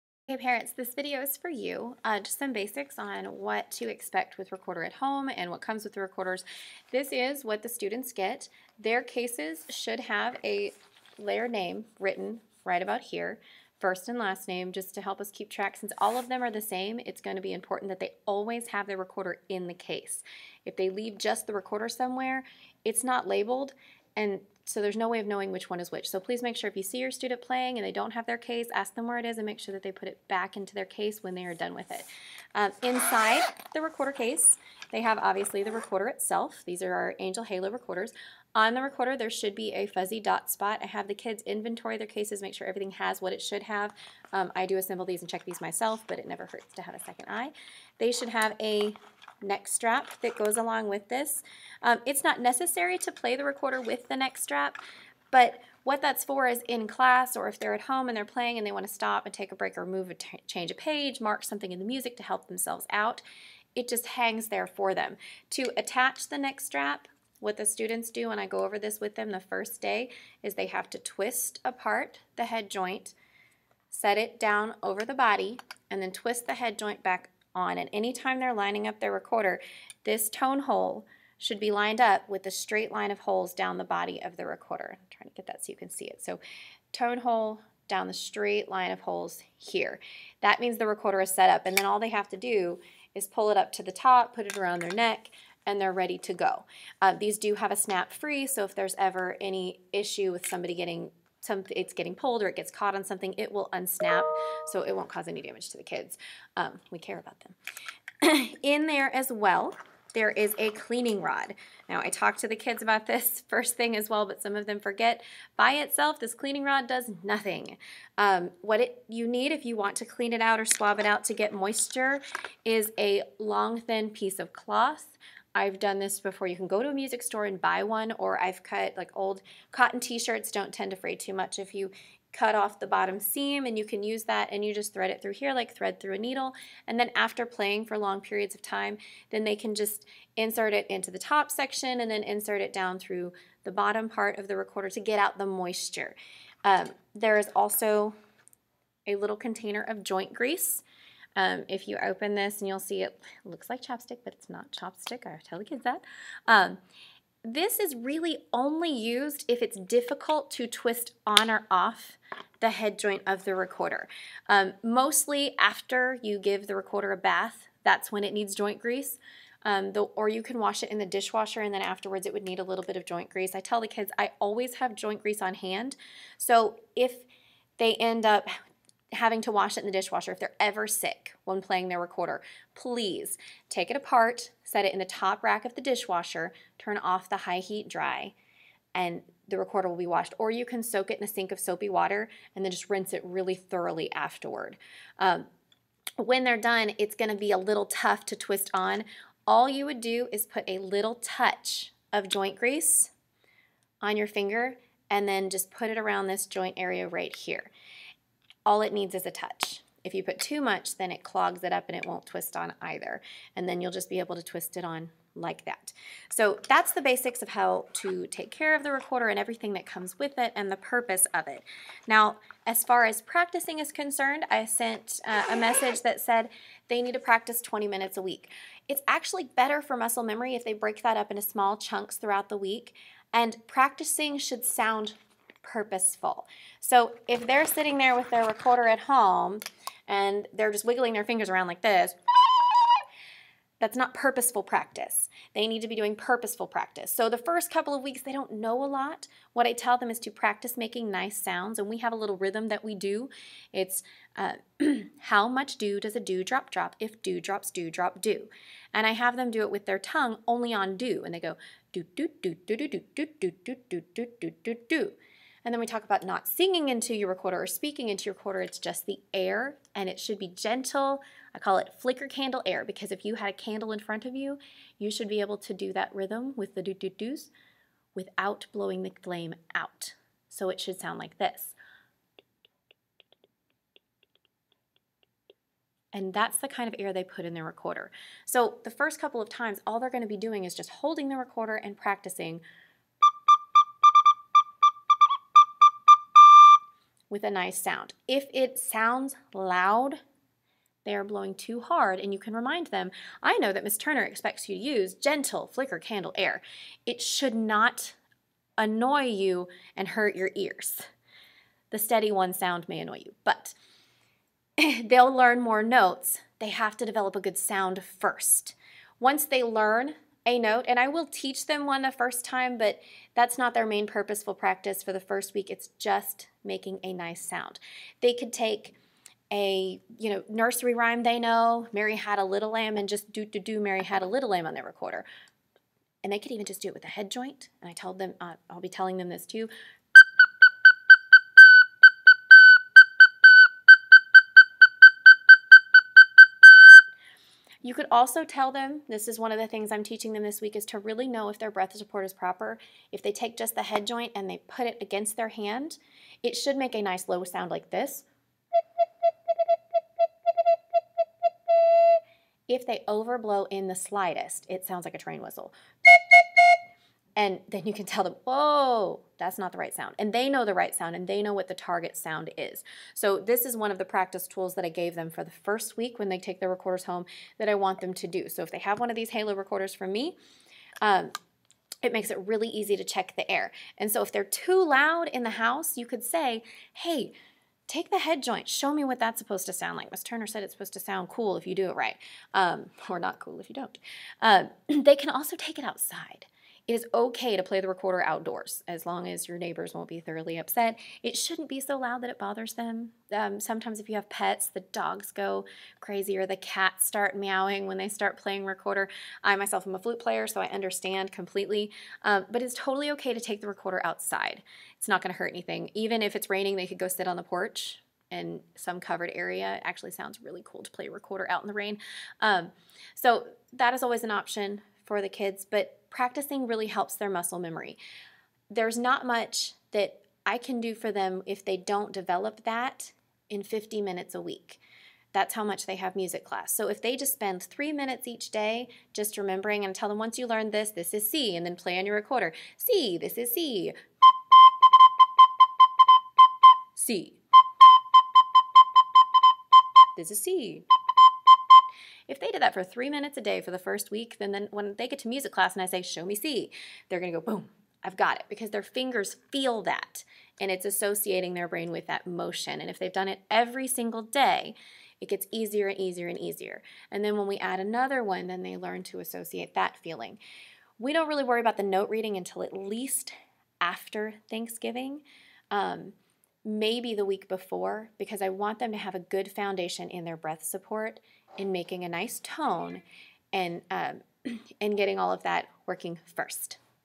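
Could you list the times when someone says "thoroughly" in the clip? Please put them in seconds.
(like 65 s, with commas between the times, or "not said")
193 s, 400 s.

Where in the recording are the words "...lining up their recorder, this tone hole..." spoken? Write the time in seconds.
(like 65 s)
78 s.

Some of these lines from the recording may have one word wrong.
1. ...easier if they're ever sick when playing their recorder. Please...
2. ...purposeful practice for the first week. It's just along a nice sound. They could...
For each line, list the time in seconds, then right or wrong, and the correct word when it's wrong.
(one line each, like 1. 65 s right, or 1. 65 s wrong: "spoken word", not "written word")
1. 179 s wrong: "dishwasher", not "easier"
2. 324 s wrong: "making", not "along".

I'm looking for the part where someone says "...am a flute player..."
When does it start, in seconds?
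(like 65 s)
409 s.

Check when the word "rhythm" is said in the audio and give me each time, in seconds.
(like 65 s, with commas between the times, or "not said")
252 s, 276 s.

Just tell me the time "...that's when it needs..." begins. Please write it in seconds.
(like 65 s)
167 s.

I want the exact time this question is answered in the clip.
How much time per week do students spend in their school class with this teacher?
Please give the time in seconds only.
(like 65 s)
433 s.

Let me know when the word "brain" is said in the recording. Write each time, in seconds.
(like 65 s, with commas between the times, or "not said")
461 s.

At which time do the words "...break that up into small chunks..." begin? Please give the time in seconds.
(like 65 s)
230 s.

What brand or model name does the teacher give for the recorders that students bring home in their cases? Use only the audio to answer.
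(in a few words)
Angel Halo.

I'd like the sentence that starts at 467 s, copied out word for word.
And then when we add another one, then they learn to associate that feeling.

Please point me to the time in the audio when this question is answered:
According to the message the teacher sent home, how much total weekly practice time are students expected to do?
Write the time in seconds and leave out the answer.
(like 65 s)
227 s.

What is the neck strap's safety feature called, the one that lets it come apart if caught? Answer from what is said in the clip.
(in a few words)
snap free.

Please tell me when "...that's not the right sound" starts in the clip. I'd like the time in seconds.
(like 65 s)
369 s.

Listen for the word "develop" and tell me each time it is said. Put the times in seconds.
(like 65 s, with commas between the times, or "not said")
317 s, 432 s.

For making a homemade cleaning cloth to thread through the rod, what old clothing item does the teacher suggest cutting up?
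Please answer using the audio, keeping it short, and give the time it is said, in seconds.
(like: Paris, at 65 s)
cotton t-shirts, at 129 s.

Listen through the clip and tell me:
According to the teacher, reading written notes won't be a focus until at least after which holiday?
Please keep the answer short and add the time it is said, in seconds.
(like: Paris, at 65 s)
Thanksgiving, at 474 s.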